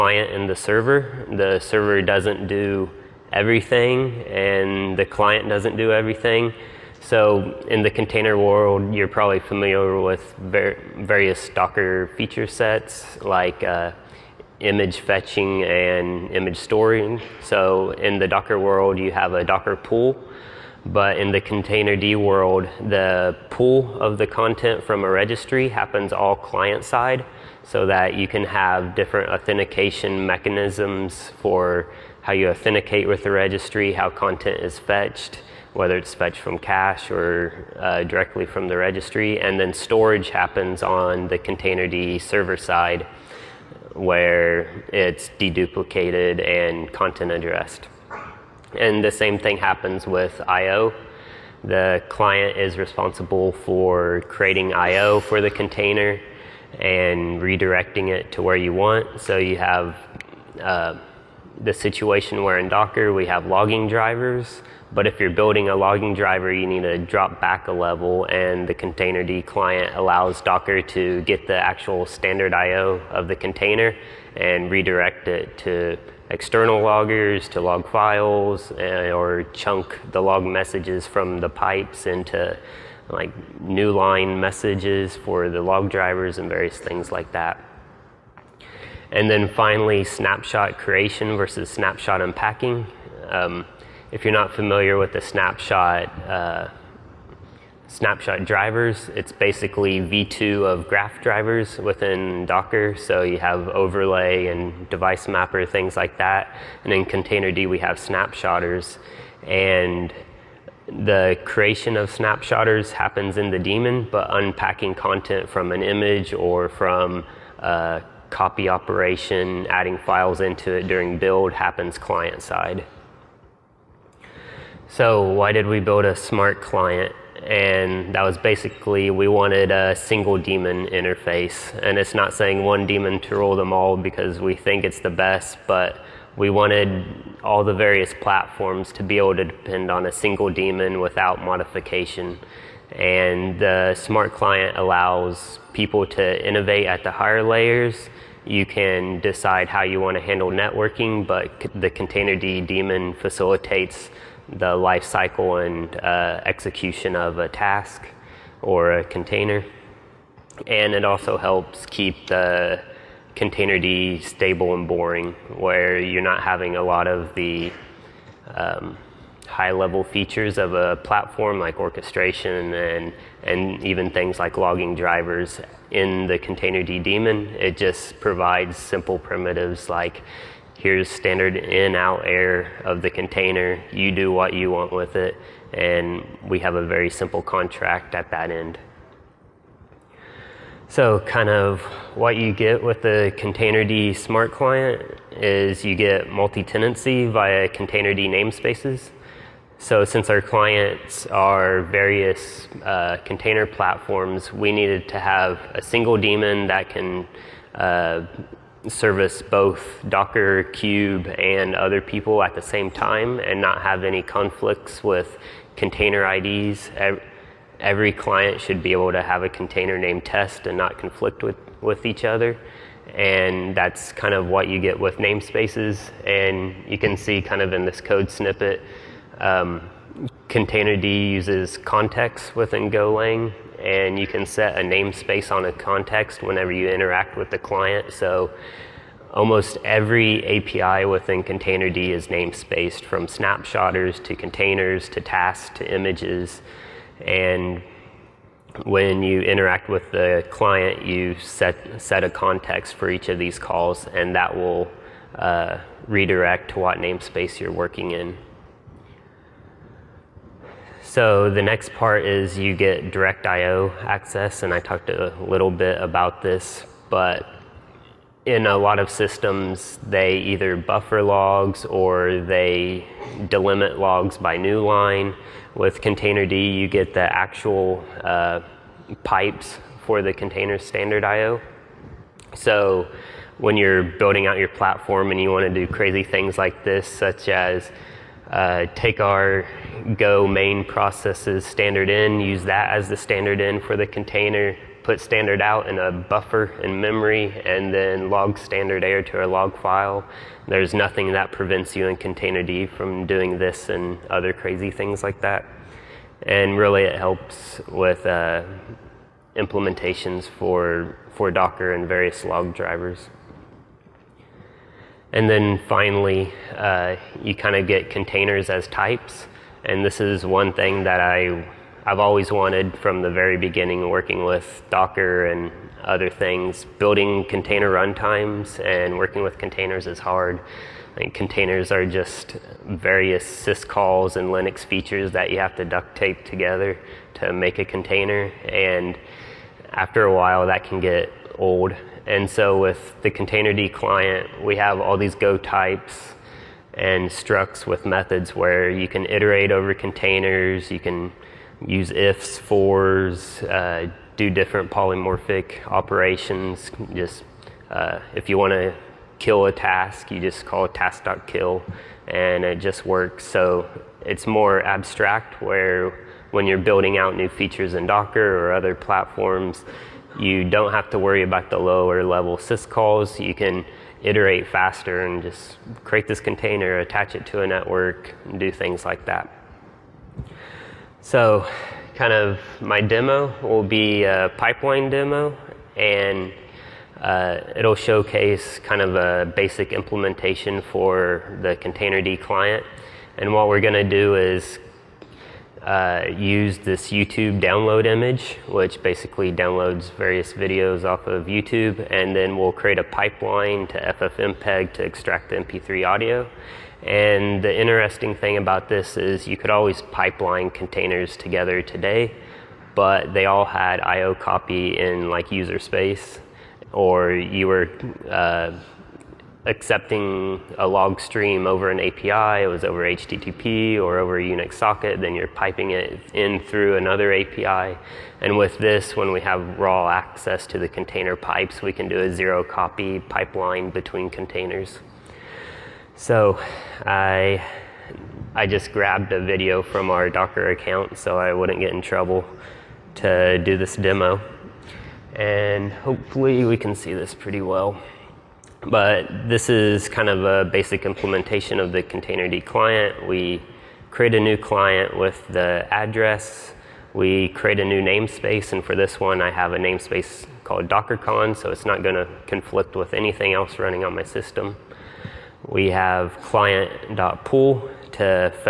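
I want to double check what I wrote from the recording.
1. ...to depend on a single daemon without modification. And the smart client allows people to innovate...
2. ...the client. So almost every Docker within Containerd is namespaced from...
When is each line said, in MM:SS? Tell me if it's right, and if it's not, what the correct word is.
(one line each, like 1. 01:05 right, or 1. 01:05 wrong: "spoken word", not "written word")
1. 02:19 right
2. 03:57 wrong: "API", not "Docker".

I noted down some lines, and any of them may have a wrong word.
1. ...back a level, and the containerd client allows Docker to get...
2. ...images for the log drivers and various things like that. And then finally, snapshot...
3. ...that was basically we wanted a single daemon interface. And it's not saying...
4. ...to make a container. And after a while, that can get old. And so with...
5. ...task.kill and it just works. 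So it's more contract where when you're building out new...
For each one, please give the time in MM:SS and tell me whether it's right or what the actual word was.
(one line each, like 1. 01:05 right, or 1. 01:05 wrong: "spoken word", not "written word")
1. 01:07 right
2. 01:24 wrong: "messages", not "images"
3. 02:08 right
4. 05:37 right
5. 06:00 wrong: "abstract", not "contract".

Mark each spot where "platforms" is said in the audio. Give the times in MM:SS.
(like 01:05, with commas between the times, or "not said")
02:18, 02:50, 03:23, 04:44, 06:08.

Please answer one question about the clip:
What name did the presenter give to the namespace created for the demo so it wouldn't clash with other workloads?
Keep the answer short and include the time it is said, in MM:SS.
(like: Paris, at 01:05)
DockerCon, at 07:40.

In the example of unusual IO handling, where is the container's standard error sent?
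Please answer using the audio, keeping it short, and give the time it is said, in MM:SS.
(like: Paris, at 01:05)
a log file, at 04:58.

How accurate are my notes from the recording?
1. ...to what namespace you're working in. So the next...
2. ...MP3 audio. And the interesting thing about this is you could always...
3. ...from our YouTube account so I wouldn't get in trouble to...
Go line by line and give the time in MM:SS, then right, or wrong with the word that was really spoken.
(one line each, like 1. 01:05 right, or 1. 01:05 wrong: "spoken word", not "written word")
1. 04:16 right
2. 06:45 right
3. 07:19 wrong: "Docker", not "YouTube".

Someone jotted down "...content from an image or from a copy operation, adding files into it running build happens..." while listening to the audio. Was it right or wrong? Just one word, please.
wrong.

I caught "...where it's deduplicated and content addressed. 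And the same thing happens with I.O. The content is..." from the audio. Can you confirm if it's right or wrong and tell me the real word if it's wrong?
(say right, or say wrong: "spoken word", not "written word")
wrong: "client", not "content".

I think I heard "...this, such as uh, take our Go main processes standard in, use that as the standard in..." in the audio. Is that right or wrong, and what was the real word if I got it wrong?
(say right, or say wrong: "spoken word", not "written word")
right.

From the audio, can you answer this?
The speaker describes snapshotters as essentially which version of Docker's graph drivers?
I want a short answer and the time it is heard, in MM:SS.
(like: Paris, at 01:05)
v2, at 01:39.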